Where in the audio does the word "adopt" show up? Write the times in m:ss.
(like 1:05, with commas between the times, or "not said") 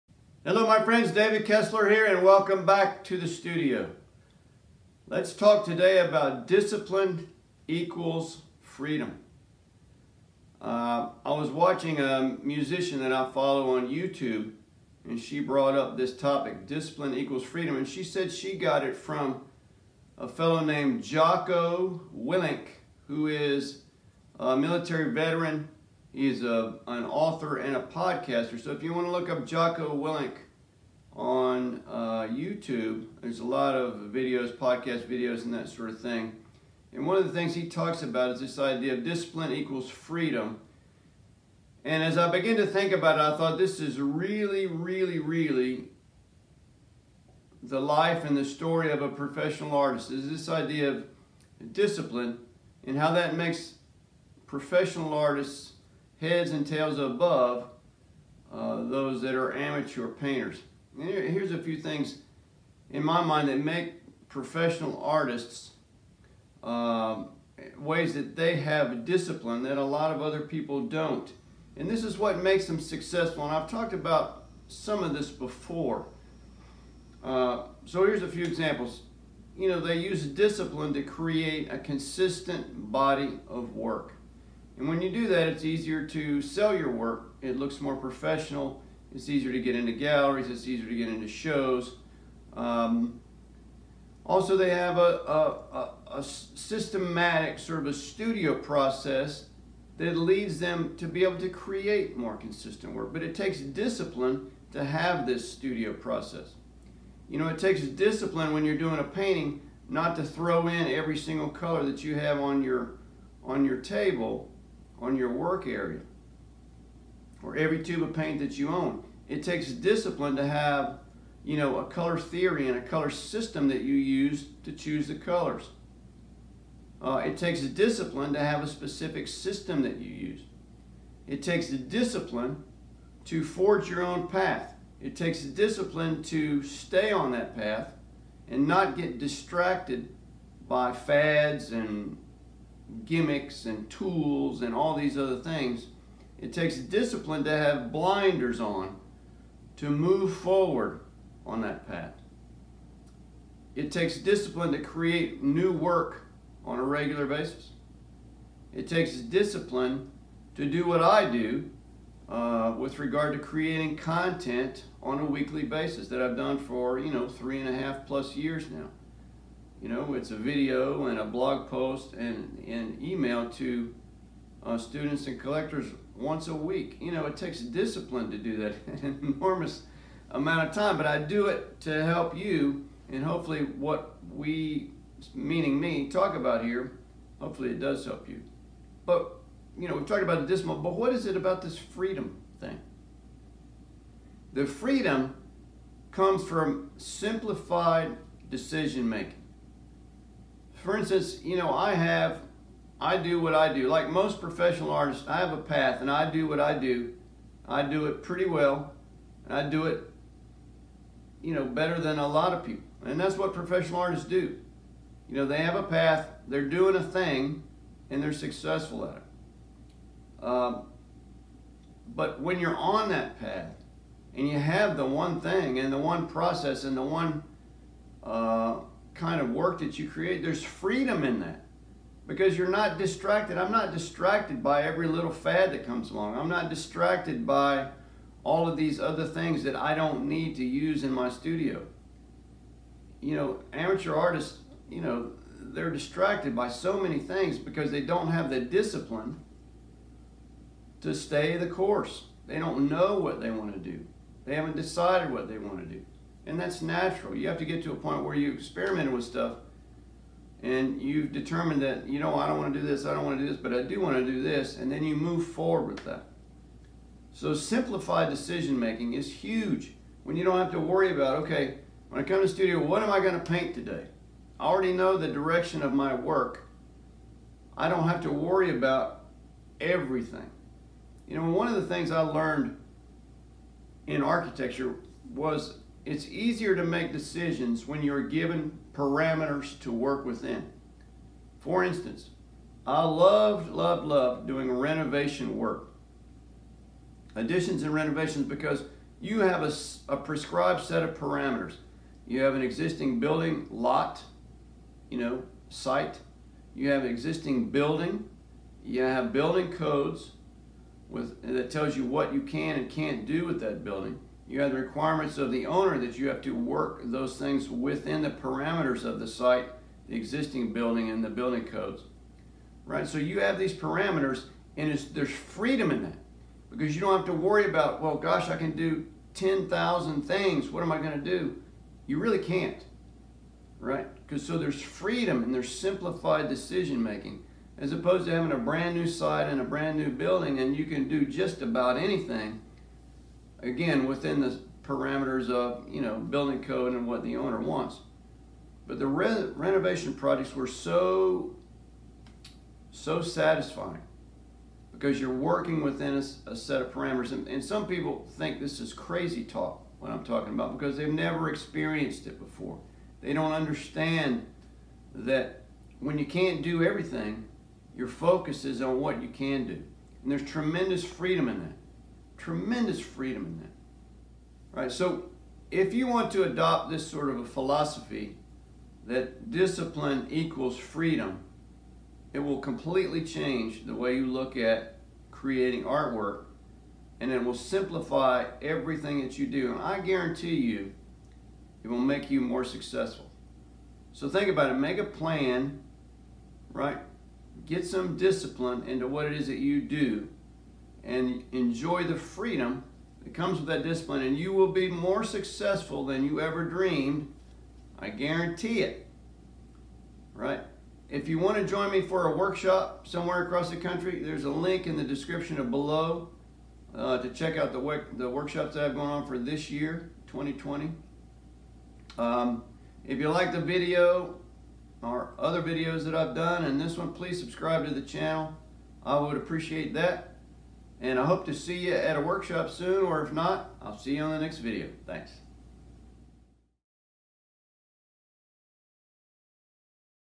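6:16.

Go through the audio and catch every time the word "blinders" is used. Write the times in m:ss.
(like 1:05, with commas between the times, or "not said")
2:27.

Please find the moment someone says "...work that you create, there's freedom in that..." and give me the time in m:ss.
3:49.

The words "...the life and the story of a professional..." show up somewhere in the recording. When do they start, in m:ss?
0:47.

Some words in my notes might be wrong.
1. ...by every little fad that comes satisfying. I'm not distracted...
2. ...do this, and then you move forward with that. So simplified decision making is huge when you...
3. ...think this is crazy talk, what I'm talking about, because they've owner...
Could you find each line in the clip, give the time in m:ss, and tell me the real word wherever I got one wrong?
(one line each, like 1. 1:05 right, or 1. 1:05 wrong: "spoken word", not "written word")
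1. 3:54 wrong: "along", not "satisfying"
2. 4:24 right
3. 5:58 wrong: "never", not "owner".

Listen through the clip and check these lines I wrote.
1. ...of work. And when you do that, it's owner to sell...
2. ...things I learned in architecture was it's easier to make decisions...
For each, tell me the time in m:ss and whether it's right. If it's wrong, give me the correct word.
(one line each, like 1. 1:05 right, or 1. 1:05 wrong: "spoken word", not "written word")
1. 1:23 wrong: "easier", not "owner"
2. 4:41 right.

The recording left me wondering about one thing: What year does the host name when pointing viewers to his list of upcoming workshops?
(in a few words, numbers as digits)
2020.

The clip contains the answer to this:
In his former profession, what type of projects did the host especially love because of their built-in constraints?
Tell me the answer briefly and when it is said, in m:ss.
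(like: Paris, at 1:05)
Additions and renovations, at 4:57.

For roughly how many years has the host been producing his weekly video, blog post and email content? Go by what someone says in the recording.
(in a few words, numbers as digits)
3.5 years.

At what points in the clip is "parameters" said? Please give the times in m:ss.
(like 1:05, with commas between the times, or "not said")
4:48, 5:01, 5:18, 5:23, 5:44, 5:56.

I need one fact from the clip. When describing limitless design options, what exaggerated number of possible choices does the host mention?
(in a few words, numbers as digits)
10,000.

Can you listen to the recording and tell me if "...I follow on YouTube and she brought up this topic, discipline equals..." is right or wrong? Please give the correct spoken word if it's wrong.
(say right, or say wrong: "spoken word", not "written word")
right.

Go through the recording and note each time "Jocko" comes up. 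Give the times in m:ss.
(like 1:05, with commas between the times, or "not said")
0:21, 0:29.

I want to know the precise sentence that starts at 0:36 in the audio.
And one of the things he talks about is this idea of discipline equals freedom.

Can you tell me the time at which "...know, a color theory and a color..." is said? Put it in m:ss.
2:01.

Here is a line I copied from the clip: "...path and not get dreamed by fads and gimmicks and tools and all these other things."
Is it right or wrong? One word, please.
wrong.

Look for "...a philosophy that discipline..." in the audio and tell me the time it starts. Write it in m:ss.
6:17.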